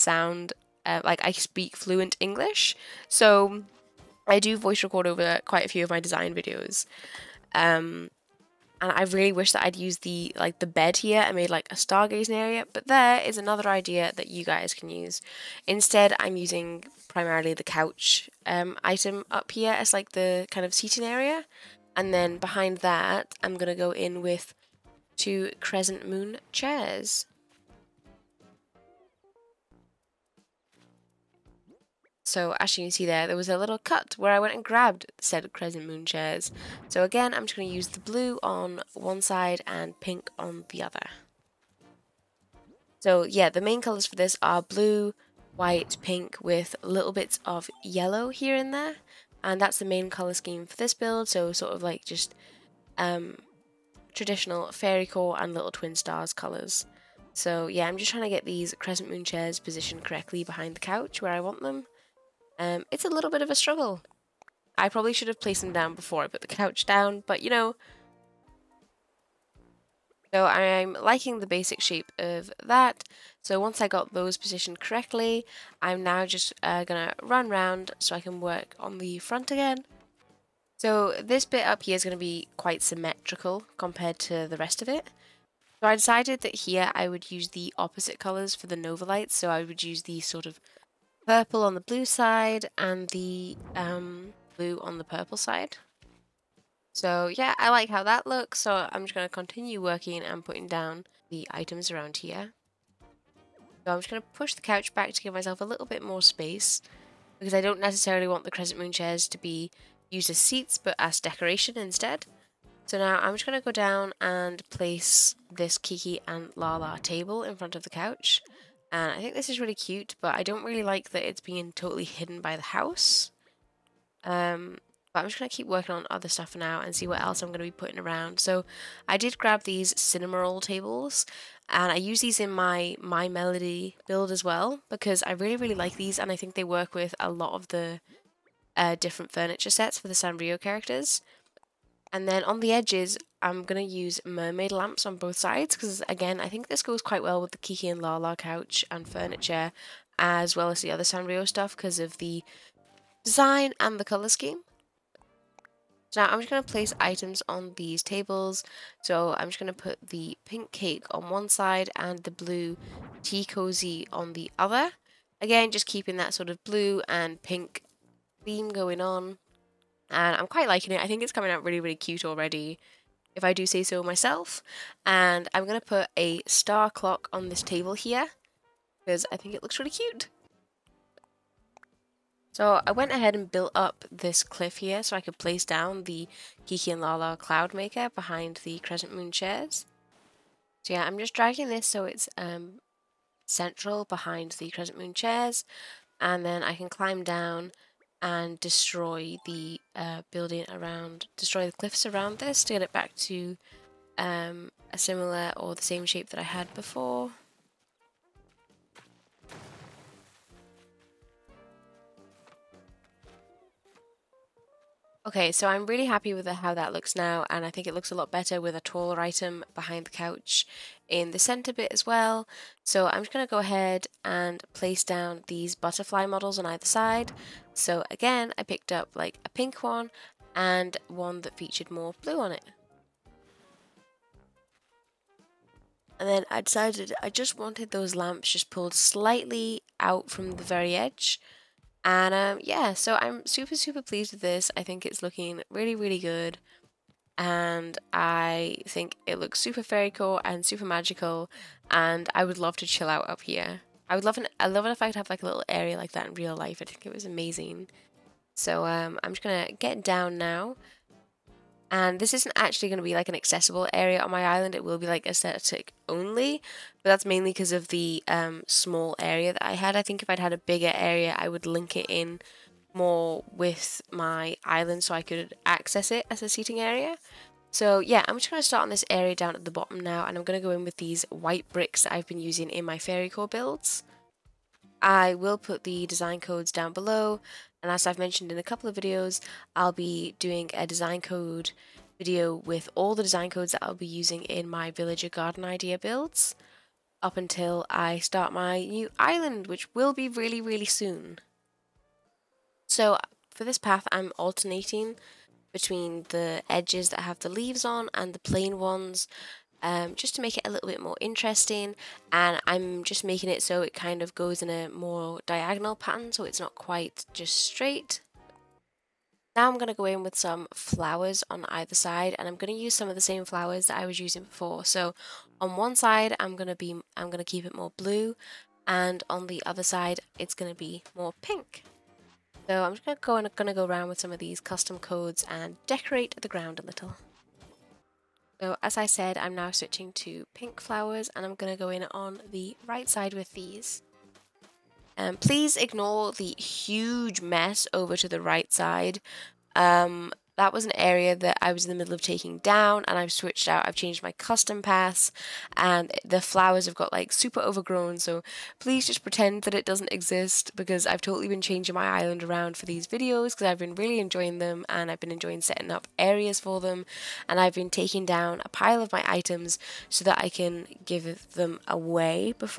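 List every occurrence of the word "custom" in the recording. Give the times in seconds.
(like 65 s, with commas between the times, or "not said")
334 s, 354 s.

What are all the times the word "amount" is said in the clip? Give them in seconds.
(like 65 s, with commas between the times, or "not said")
not said.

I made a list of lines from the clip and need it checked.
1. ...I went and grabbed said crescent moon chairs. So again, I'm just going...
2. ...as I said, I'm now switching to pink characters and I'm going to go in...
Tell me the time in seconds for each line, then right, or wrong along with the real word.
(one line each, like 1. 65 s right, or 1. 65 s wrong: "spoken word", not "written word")
1. 34 s right
2. 338 s wrong: "flowers", not "characters".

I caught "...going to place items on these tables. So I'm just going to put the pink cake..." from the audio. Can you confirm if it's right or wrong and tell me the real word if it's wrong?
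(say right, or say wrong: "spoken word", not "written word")
right.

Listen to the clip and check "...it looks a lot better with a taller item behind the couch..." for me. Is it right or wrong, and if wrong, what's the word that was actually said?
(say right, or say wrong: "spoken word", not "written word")
right.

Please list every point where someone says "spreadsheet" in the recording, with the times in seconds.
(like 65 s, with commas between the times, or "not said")
not said.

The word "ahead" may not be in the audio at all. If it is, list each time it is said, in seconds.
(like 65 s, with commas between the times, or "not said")
183 s, 223 s.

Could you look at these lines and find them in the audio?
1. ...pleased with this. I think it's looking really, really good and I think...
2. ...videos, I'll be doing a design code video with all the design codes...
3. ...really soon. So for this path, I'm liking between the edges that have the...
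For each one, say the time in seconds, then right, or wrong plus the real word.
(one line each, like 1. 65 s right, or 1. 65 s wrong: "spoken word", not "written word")
1. 244 s right
2. 288 s right
3. 300 s wrong: "alternating", not "liking".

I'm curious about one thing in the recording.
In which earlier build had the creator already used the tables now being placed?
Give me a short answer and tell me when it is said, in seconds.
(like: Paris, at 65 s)
My Melody build, at 133 s.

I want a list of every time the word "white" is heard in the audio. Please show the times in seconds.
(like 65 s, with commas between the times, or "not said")
45 s, 281 s.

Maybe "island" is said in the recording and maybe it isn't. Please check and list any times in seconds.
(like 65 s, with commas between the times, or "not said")
264 s, 274 s, 299 s, 362 s.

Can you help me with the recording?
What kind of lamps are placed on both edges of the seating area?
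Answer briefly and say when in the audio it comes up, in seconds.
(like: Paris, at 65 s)
Mermaid lamps, at 144 s.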